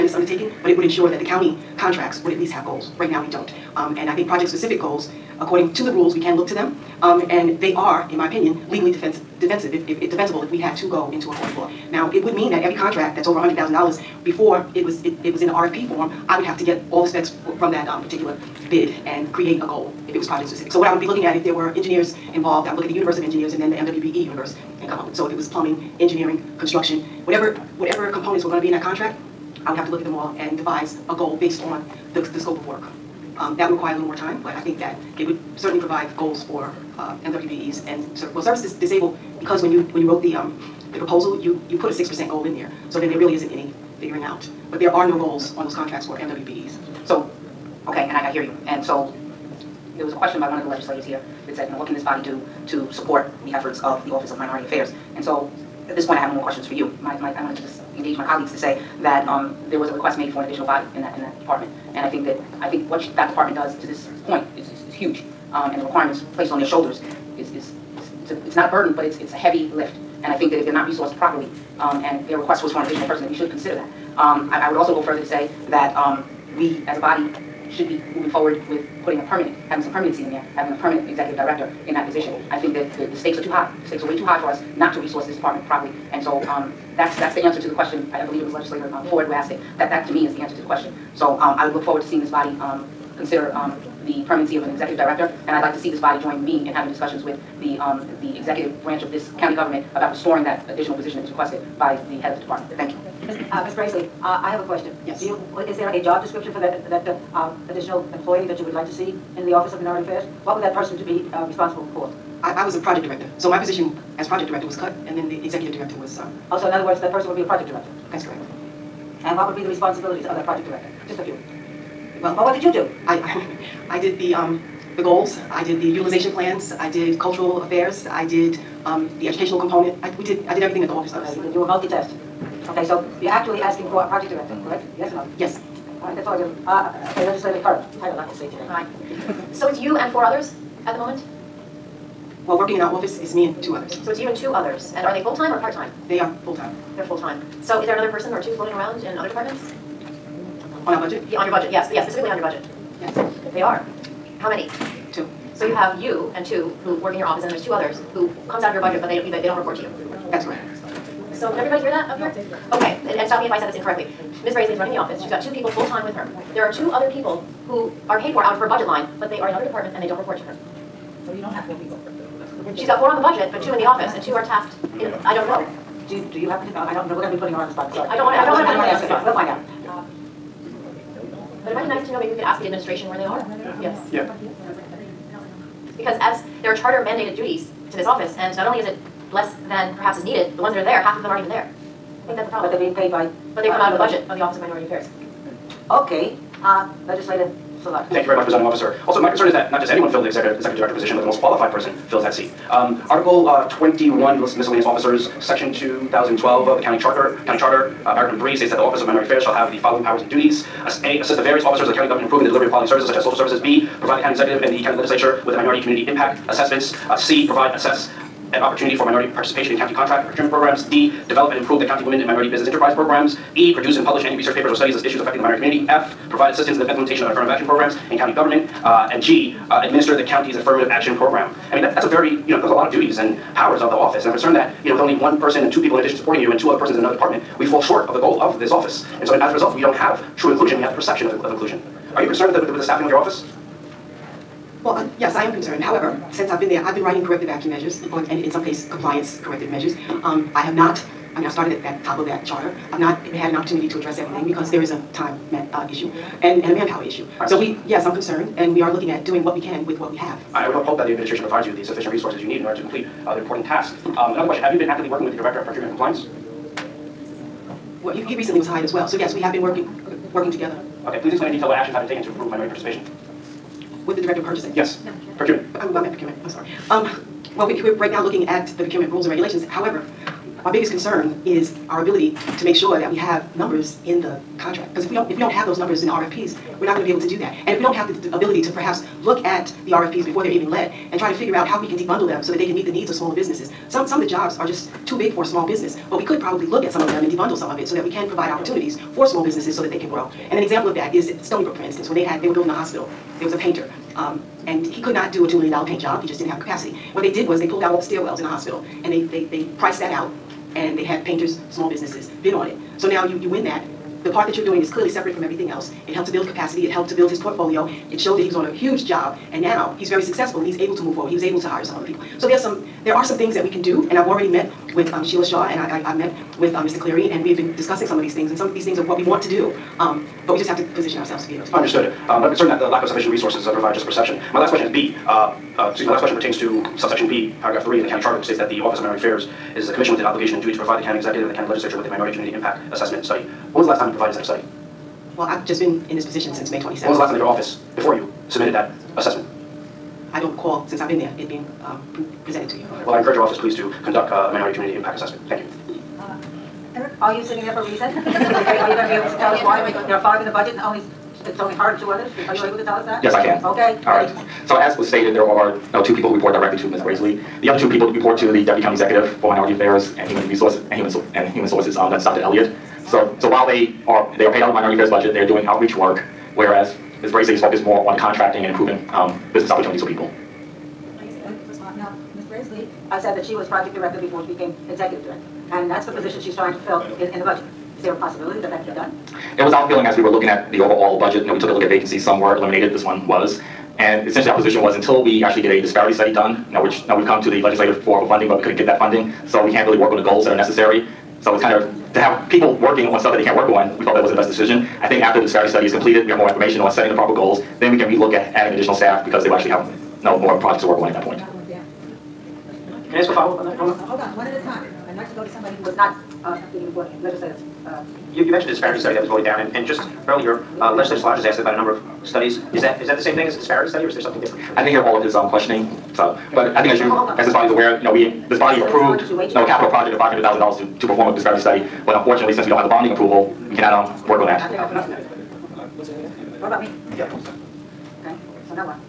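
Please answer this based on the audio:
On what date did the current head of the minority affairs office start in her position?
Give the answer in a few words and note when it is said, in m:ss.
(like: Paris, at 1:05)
May 27th, at 5:46.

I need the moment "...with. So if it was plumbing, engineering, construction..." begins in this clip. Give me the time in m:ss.
0:25.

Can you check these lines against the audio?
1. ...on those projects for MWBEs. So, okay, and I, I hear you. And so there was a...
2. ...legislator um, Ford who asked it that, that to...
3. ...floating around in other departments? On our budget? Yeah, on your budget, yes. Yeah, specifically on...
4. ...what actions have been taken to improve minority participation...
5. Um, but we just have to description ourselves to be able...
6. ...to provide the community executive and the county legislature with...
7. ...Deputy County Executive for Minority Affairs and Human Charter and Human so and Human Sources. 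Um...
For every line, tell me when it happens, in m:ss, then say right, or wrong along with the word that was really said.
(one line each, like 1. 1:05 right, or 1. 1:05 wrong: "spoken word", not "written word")
1. 0:45 wrong: "contracts", not "projects"
2. 1:28 right
3. 2:28 right
4. 4:31 right
5. 5:29 wrong: "position", not "description"
6. 5:40 wrong: "county", not "community"
7. 6:08 wrong: "Resources", not "Charter".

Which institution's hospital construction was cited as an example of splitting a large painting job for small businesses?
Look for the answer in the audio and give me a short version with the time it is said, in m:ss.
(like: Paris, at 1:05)
Stony Brook, at 5:01.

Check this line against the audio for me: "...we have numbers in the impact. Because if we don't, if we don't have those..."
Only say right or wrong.
wrong.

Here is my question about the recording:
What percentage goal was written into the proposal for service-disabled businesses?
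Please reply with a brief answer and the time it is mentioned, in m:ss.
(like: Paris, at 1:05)
6 percent, at 0:41.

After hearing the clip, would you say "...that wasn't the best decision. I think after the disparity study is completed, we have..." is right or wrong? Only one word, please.
right.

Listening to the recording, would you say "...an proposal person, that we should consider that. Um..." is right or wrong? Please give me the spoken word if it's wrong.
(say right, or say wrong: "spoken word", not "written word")
wrong: "additional", not "proposal".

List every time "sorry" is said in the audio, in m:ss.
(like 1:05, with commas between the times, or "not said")
2:57, 4:36.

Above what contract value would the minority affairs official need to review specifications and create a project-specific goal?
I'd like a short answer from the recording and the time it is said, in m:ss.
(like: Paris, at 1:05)
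$100,000, at 0:13.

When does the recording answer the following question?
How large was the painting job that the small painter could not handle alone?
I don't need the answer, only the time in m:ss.
5:05.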